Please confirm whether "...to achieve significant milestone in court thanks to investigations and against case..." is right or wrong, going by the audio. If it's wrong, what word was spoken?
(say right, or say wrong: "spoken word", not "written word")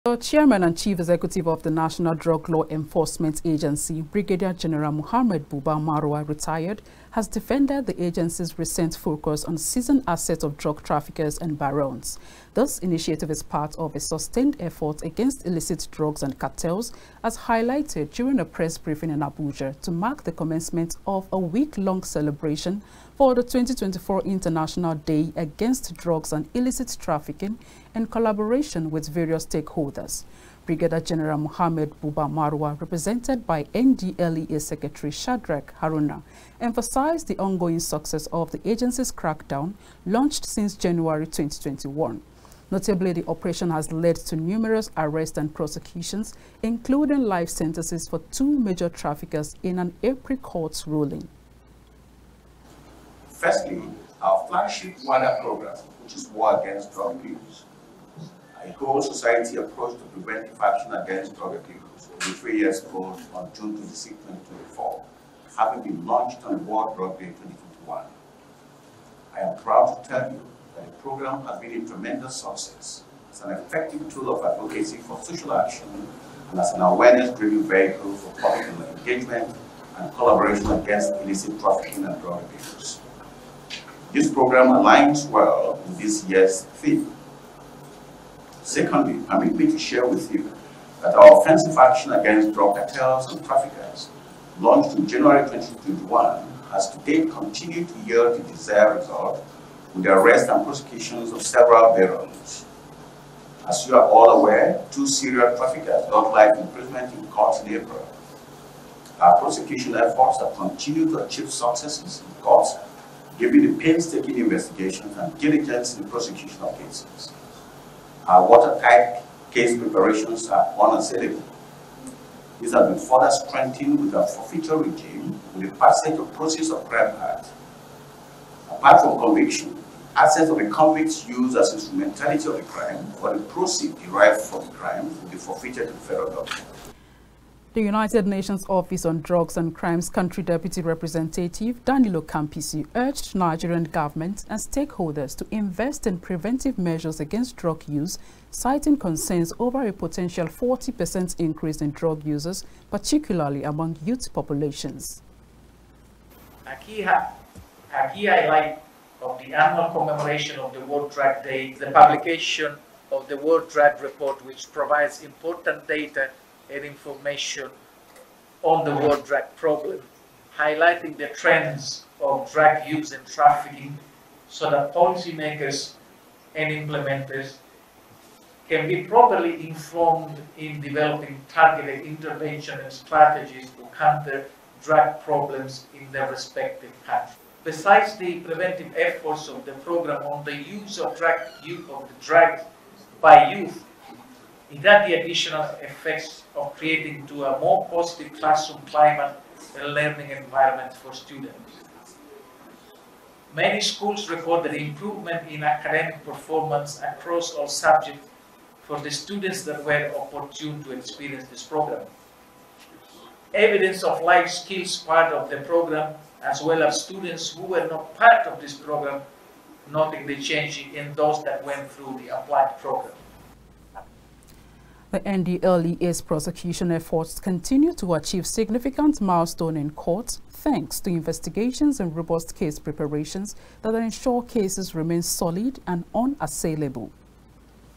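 wrong: "robust", not "against".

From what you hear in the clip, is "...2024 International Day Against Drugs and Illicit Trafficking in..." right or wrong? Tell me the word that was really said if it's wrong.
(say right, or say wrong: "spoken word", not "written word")
right.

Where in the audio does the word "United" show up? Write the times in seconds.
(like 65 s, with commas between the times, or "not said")
137 s.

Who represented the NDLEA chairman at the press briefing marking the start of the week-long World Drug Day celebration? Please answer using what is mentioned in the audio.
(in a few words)
Shadrach Haruna.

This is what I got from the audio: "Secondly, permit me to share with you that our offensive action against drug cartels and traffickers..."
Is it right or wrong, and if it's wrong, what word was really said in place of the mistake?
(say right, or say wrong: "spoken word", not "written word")
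right.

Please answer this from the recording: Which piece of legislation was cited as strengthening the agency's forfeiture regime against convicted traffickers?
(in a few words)
Proceeds of Crime Act.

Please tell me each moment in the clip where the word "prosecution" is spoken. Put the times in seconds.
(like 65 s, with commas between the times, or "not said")
45 s, 100 s, 109 s, 116 s, 226 s.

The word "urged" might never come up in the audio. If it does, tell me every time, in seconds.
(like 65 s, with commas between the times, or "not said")
142 s.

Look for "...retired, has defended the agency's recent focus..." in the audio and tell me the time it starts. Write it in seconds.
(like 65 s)
6 s.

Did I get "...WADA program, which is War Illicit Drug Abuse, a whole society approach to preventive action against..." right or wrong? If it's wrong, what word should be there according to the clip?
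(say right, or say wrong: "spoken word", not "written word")
wrong: "Against", not "Illicit".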